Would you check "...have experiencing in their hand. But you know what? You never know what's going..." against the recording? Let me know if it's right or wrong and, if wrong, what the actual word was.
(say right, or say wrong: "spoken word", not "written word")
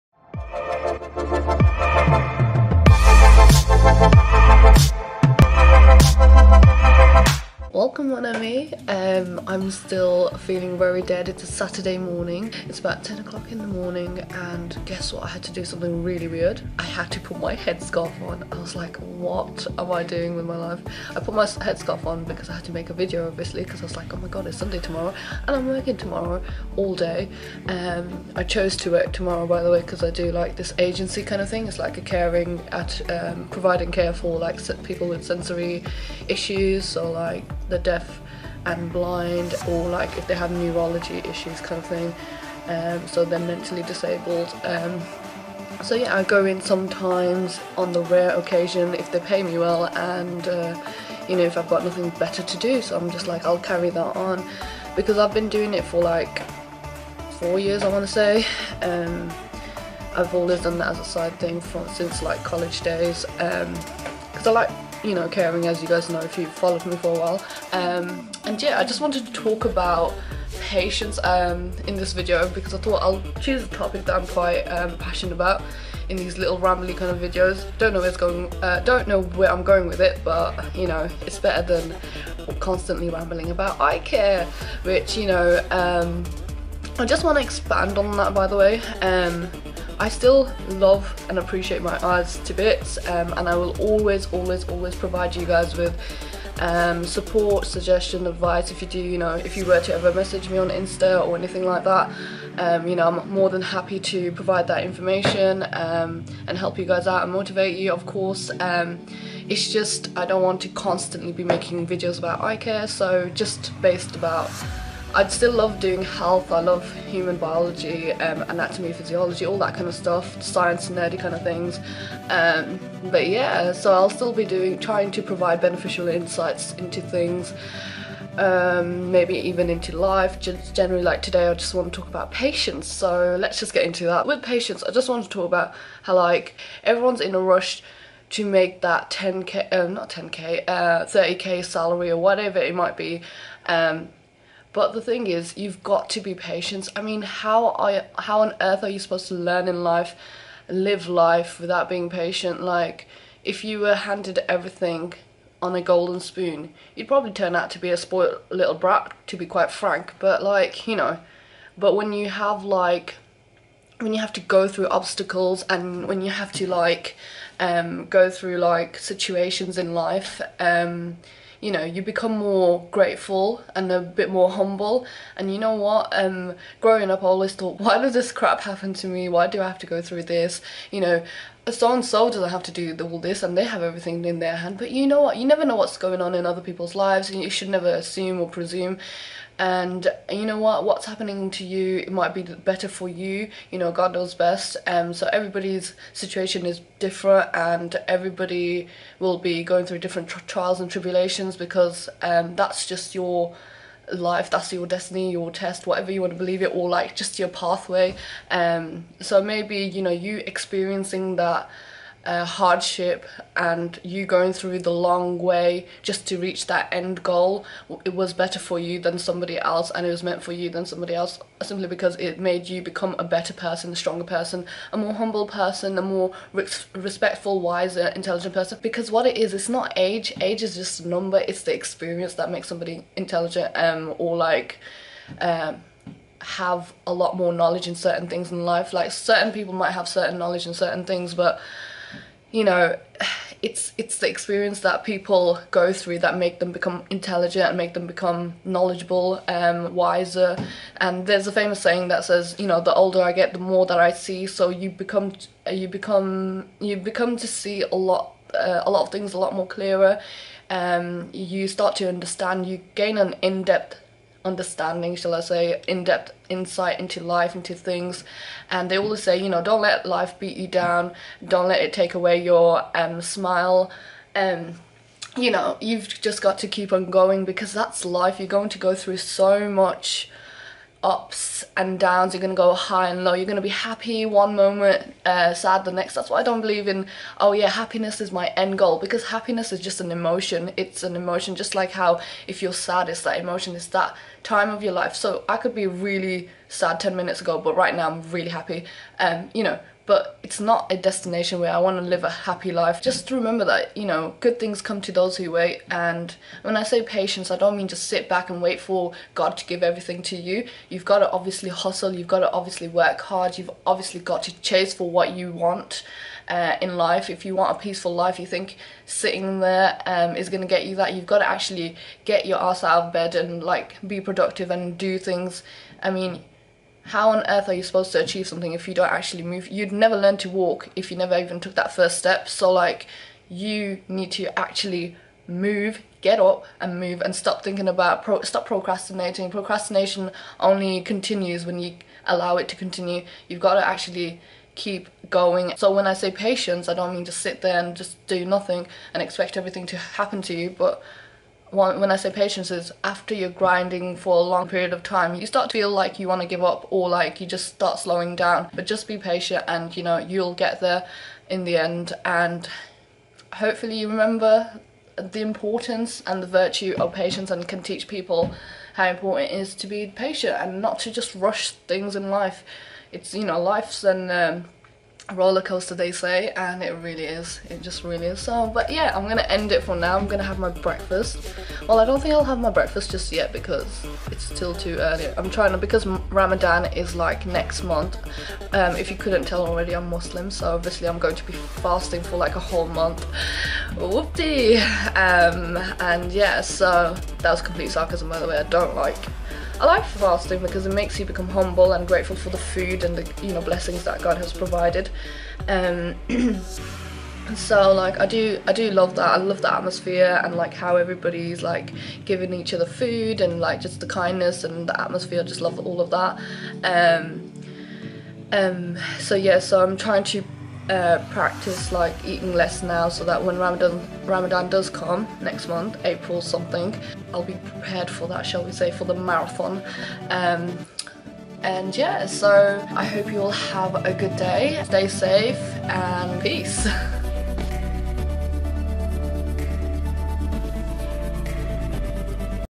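wrong: "everything", not "experiencing".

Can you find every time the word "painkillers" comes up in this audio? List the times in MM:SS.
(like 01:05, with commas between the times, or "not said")
not said.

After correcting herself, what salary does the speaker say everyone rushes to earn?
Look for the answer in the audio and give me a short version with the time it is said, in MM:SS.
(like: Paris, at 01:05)
30k, at 02:21.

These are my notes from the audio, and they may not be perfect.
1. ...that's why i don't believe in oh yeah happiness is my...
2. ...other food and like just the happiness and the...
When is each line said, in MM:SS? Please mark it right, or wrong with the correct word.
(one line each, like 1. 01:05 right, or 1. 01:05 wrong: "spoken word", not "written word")
1. 04:46 right
2. 06:52 wrong: "kindness", not "happiness".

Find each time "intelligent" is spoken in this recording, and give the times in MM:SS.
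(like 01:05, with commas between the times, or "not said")
03:48, 03:53, 04:07.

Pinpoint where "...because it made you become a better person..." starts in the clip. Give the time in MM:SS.
03:41.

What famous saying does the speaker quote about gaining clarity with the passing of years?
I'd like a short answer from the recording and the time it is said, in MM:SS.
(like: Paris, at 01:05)
The older I get the more that I see, at 04:12.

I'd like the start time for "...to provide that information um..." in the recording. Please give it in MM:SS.
01:43.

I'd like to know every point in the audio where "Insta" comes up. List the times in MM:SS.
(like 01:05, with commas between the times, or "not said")
01:40.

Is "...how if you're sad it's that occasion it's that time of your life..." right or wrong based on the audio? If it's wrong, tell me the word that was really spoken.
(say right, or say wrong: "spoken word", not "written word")
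wrong: "emotion", not "occasion".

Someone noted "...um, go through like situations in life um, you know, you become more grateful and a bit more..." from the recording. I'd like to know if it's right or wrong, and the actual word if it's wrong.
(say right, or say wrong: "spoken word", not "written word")
right.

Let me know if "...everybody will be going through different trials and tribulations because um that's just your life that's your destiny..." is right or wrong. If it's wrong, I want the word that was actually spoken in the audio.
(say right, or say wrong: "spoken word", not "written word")
right.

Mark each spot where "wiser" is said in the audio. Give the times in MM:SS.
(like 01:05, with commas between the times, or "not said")
03:47, 04:09.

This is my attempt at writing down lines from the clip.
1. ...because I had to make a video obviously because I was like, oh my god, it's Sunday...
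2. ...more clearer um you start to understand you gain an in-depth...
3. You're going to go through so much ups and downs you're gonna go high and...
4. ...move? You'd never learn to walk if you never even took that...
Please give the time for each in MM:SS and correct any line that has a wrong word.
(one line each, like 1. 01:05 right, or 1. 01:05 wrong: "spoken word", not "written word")
1. 00:22 right
2. 04:19 right
3. 04:38 right
4. 05:29 right.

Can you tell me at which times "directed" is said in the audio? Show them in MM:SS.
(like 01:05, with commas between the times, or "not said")
not said.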